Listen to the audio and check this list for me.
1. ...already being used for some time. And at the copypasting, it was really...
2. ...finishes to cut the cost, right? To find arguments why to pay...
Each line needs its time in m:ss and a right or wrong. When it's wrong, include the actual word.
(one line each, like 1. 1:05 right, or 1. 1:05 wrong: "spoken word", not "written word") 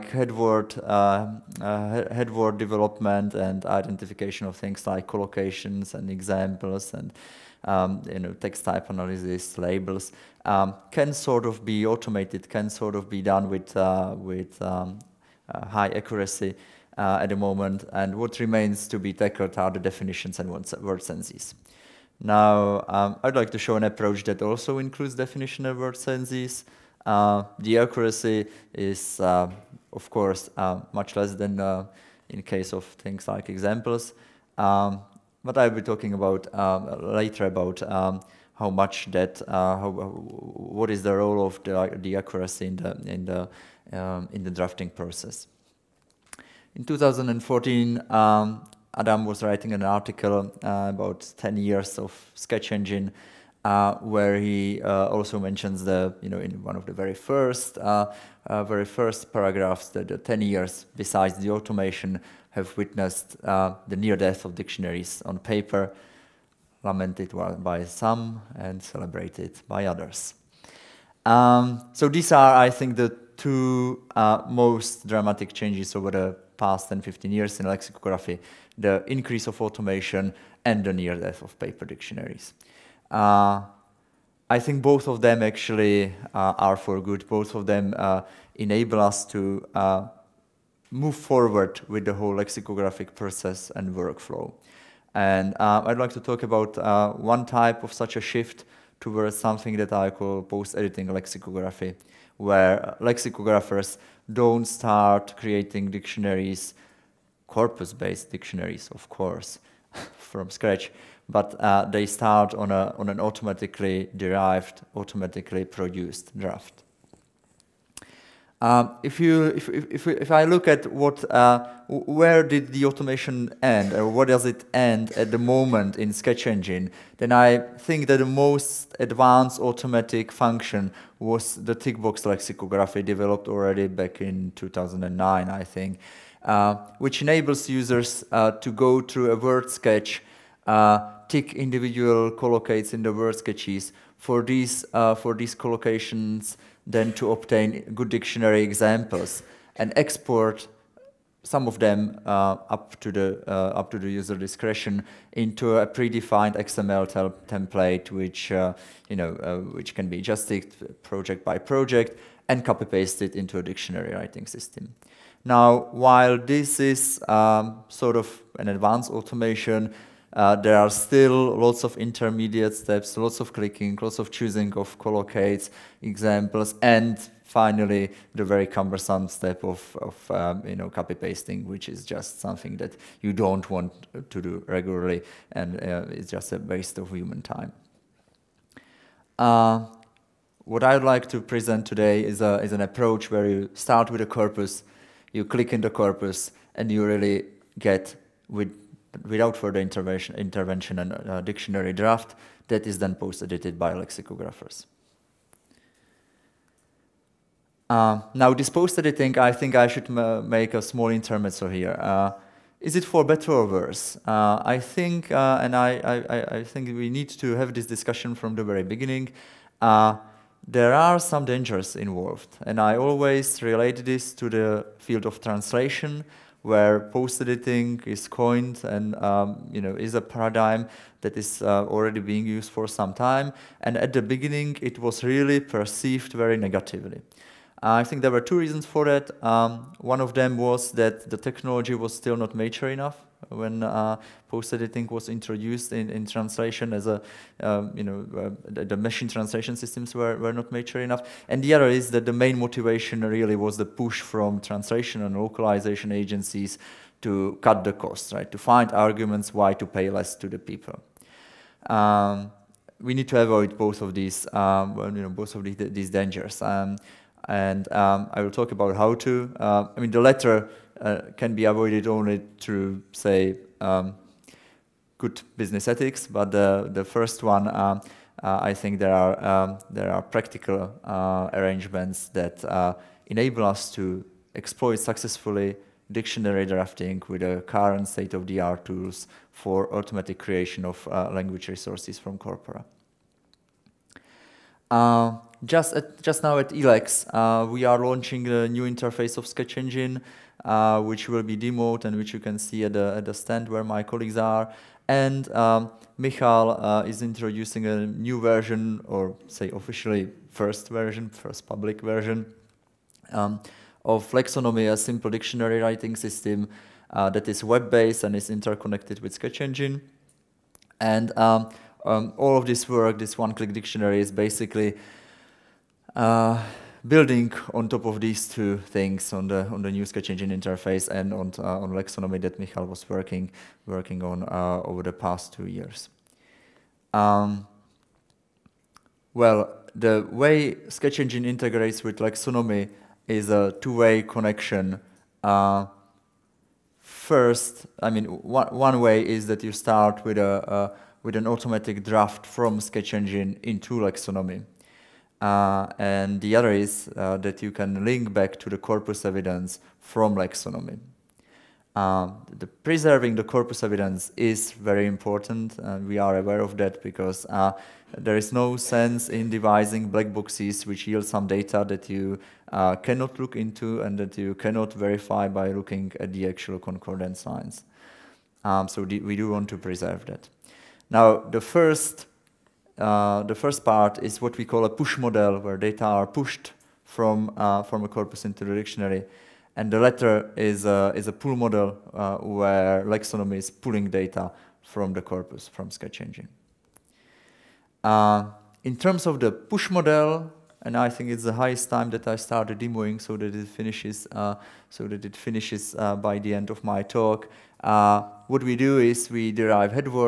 1. 3:51 wrong: "beginning", not "copypasting"
2. 4:16 wrong: "agencies", not "finishes".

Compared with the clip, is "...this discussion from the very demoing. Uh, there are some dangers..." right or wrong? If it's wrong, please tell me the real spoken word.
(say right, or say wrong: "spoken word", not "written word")
wrong: "beginning", not "demoing".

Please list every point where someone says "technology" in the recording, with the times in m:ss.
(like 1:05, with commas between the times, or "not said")
4:01.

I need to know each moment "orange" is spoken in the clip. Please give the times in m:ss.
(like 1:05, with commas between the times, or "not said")
not said.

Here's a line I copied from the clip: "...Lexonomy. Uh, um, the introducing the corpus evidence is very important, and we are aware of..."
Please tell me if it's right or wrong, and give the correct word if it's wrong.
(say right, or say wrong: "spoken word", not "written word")
wrong: "preserving", not "introducing".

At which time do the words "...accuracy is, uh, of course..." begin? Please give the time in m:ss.
0:27.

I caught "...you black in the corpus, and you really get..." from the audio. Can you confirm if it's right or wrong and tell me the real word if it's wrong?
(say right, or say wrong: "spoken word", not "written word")
wrong: "click", not "black".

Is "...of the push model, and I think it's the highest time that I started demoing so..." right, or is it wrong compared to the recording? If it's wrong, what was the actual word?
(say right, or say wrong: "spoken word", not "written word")
right.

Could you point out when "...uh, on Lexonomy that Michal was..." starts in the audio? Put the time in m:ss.
5:31.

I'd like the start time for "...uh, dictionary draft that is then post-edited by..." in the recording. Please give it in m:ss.
3:21.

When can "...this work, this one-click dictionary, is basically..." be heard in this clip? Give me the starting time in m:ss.
5:22.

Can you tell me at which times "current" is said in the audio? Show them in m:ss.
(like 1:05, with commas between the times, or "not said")
4:47.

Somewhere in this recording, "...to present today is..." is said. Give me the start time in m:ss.
3:11.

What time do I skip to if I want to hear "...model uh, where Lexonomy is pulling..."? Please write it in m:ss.
6:31.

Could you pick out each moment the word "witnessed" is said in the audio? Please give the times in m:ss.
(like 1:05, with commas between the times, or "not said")
1:02.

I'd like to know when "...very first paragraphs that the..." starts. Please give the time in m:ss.
0:58.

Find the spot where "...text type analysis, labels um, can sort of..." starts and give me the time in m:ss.
0:08.